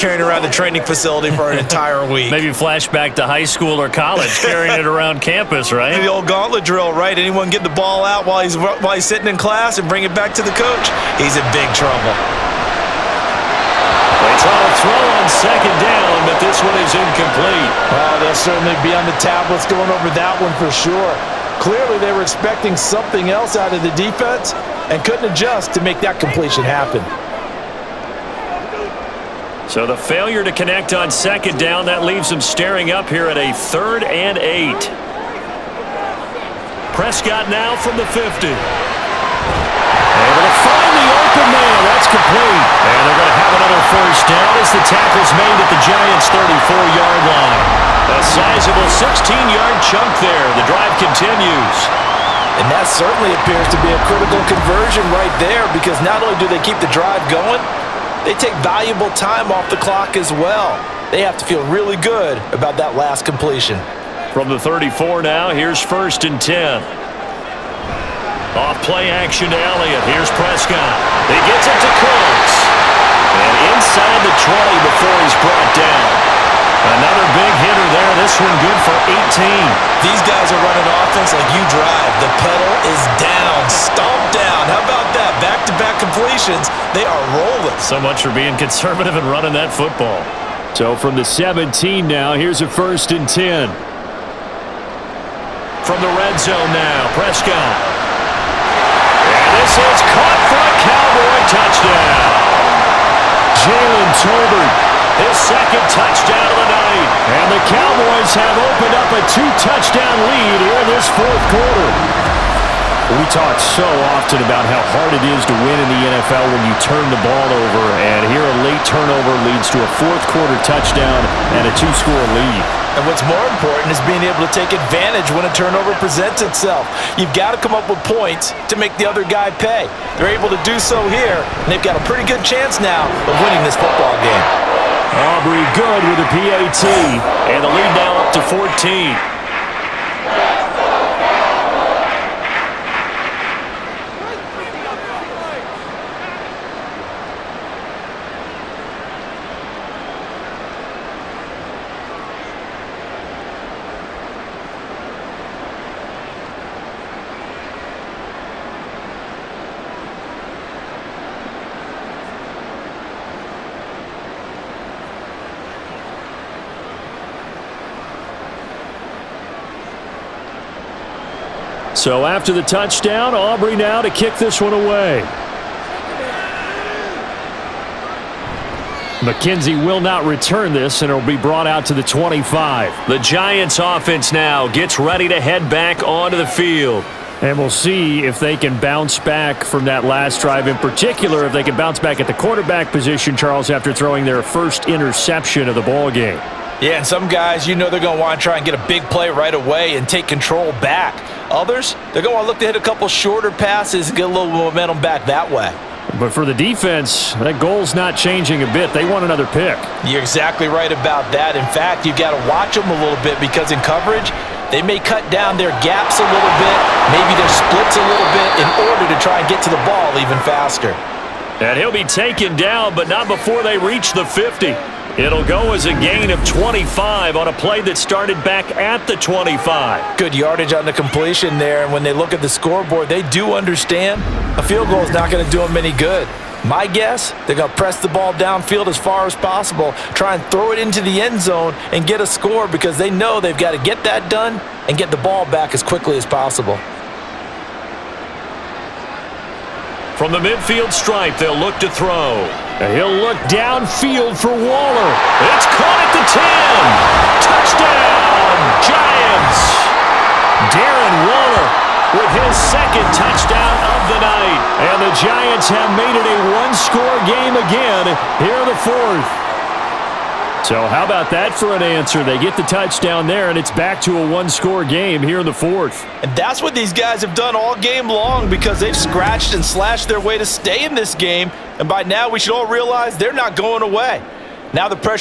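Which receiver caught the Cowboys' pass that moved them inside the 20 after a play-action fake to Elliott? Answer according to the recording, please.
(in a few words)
Cooks.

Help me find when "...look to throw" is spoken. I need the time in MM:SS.
04:11.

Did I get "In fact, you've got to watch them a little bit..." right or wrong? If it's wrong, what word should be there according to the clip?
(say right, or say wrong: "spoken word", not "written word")
right.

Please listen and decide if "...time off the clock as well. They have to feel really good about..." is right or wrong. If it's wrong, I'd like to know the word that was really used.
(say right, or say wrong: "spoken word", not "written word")
right.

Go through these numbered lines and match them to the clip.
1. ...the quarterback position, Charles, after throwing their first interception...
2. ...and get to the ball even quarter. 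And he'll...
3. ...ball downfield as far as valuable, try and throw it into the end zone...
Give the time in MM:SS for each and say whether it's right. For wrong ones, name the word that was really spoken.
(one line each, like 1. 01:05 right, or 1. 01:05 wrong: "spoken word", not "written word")
1. 03:12 right
2. 03:39 wrong: "faster", not "quarter"
3. 03:58 wrong: "possible", not "valuable".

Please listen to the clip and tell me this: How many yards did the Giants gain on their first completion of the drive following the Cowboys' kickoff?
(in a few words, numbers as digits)
25.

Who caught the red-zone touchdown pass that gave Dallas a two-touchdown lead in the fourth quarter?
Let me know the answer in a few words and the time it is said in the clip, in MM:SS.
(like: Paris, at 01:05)
Jalen Tolbert, at 01:43.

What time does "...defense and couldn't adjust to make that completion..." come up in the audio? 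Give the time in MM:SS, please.
00:23.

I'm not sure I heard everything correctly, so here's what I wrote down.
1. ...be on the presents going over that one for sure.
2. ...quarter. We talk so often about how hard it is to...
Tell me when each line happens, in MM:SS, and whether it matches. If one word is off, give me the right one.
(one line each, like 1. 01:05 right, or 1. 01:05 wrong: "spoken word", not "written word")
1. 00:18 wrong: "tablets", not "presents"
2. 01:51 right.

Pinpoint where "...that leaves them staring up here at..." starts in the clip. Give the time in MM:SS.
00:31.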